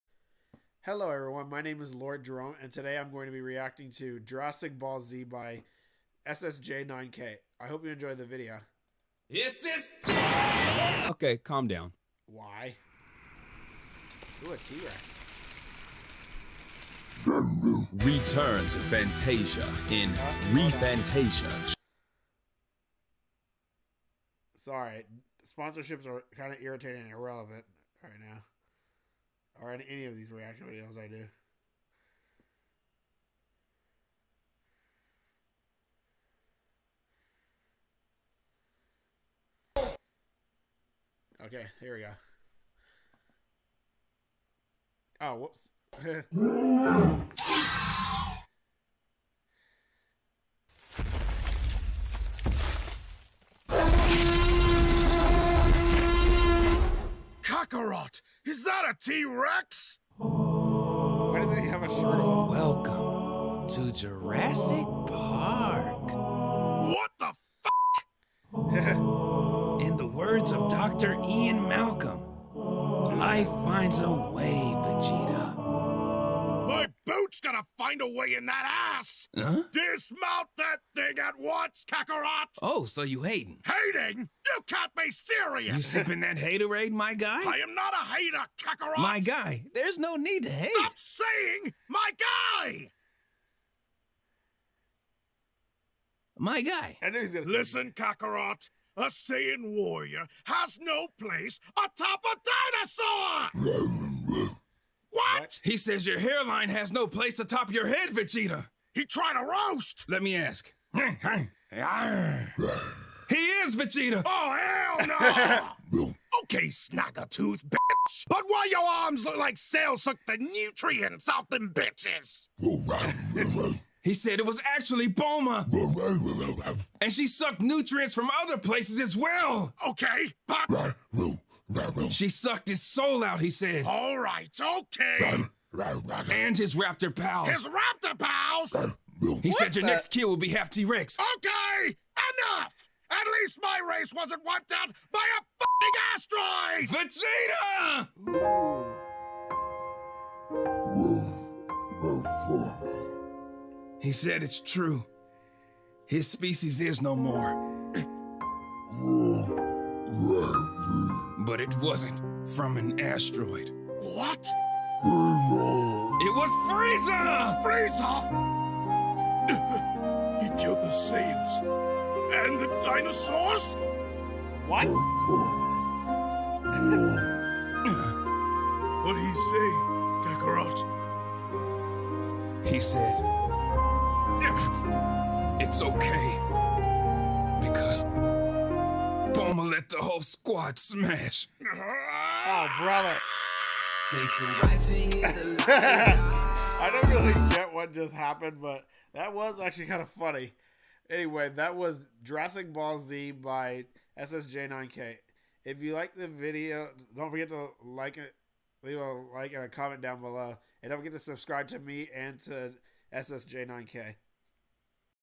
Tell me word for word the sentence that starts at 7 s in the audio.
I hope you enjoy the video.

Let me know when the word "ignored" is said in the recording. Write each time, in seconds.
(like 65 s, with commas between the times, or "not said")
not said.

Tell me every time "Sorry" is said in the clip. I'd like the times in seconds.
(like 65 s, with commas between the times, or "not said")
24 s.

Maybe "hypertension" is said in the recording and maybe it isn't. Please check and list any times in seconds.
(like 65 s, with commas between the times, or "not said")
not said.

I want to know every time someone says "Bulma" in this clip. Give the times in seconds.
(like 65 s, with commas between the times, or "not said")
125 s, 189 s.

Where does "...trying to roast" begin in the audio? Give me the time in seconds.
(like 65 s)
109 s.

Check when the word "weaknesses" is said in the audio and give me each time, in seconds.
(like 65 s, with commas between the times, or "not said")
not said.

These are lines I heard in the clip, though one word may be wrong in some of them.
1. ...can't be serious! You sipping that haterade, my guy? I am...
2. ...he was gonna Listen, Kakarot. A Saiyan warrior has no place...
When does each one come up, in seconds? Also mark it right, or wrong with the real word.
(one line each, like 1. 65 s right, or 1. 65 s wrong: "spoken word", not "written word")
1. 84 s right
2. 97 s right.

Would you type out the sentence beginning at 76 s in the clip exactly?
My boot's gonna find a way in that ass!